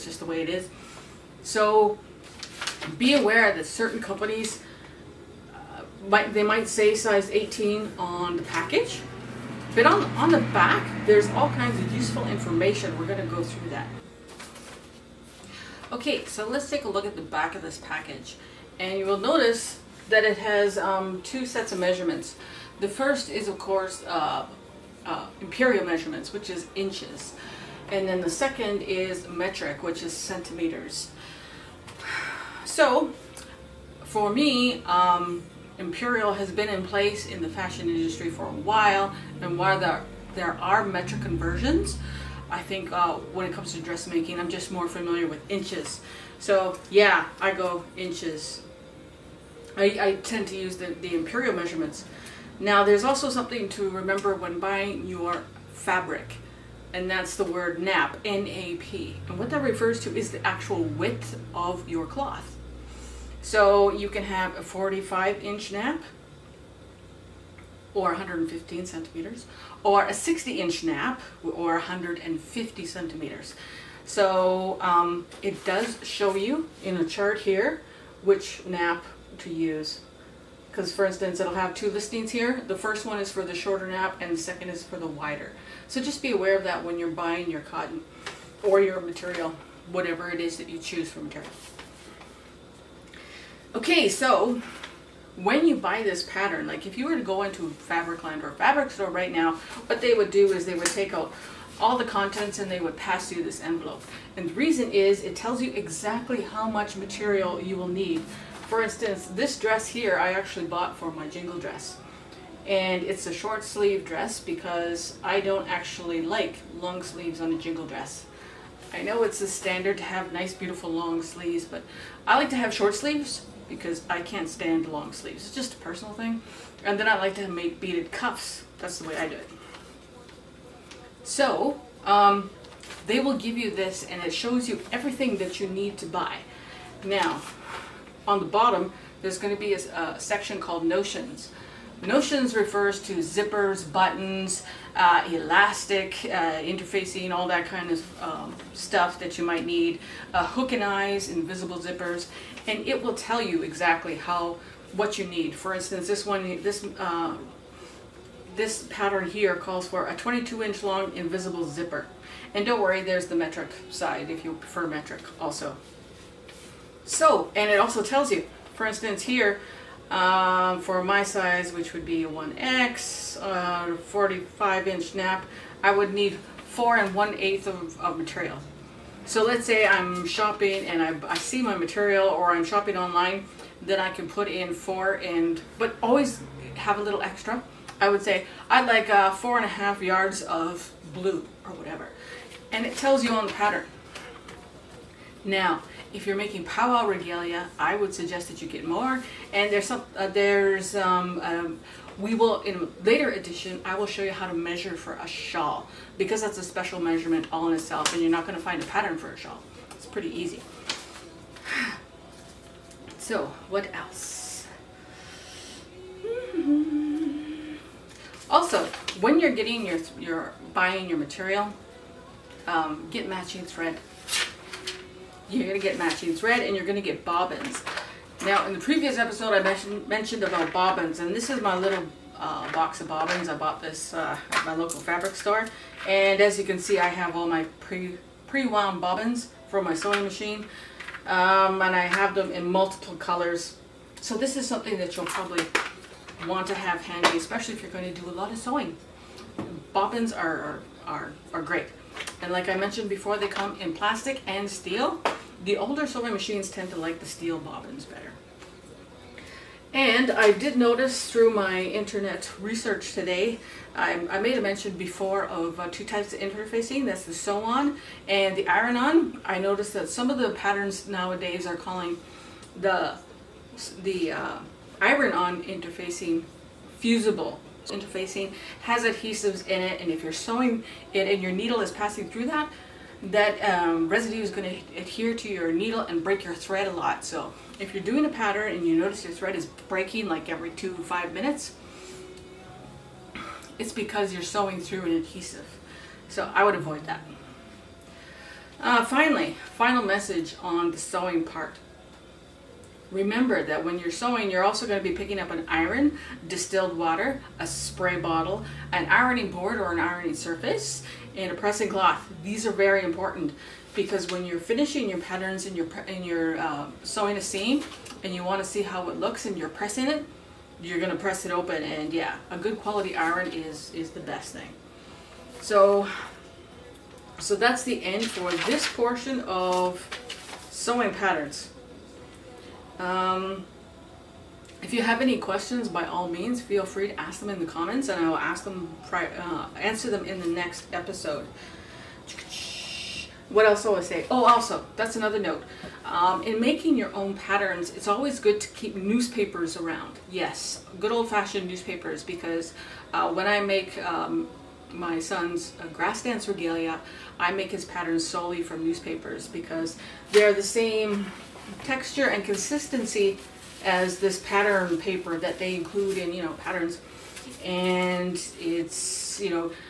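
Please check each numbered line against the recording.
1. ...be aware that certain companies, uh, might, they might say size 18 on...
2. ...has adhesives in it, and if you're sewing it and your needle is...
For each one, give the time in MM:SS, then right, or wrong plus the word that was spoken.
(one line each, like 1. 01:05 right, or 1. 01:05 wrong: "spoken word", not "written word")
1. 00:02 right
2. 04:38 right.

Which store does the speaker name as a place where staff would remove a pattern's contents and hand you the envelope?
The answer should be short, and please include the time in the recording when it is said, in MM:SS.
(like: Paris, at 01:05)
Fabricland, at 01:37.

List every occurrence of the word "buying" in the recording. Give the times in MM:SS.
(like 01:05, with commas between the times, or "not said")
00:54, 01:27, 03:40.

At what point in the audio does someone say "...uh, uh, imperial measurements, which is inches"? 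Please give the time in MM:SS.
00:24.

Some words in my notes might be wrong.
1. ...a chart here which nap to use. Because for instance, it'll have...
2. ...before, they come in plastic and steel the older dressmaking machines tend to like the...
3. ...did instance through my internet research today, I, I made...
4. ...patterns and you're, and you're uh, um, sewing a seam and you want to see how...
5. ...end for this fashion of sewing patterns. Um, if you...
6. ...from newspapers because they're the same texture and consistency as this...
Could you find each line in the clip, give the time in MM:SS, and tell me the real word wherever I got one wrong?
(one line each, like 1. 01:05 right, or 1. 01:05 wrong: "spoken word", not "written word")
1. 01:16 right
2. 04:13 wrong: "sewing", not "dressmaking"
3. 04:20 wrong: "notice", not "instance"
4. 05:15 right
5. 05:28 wrong: "portion", not "fashion"
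6. 05:58 right.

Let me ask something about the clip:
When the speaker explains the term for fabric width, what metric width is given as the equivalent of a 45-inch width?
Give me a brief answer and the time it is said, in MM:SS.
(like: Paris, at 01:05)
115 centimeters, at 01:08.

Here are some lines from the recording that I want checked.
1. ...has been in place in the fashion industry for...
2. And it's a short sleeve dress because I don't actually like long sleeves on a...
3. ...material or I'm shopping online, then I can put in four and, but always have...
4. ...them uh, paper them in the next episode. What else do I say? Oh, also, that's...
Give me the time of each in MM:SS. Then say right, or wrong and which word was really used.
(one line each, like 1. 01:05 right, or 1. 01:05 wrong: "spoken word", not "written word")
1. 00:36 right
2. 01:52 right
3. 03:01 right
4. 05:38 wrong: "answer", not "paper".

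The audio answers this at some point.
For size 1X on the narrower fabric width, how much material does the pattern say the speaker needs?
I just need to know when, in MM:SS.
02:56.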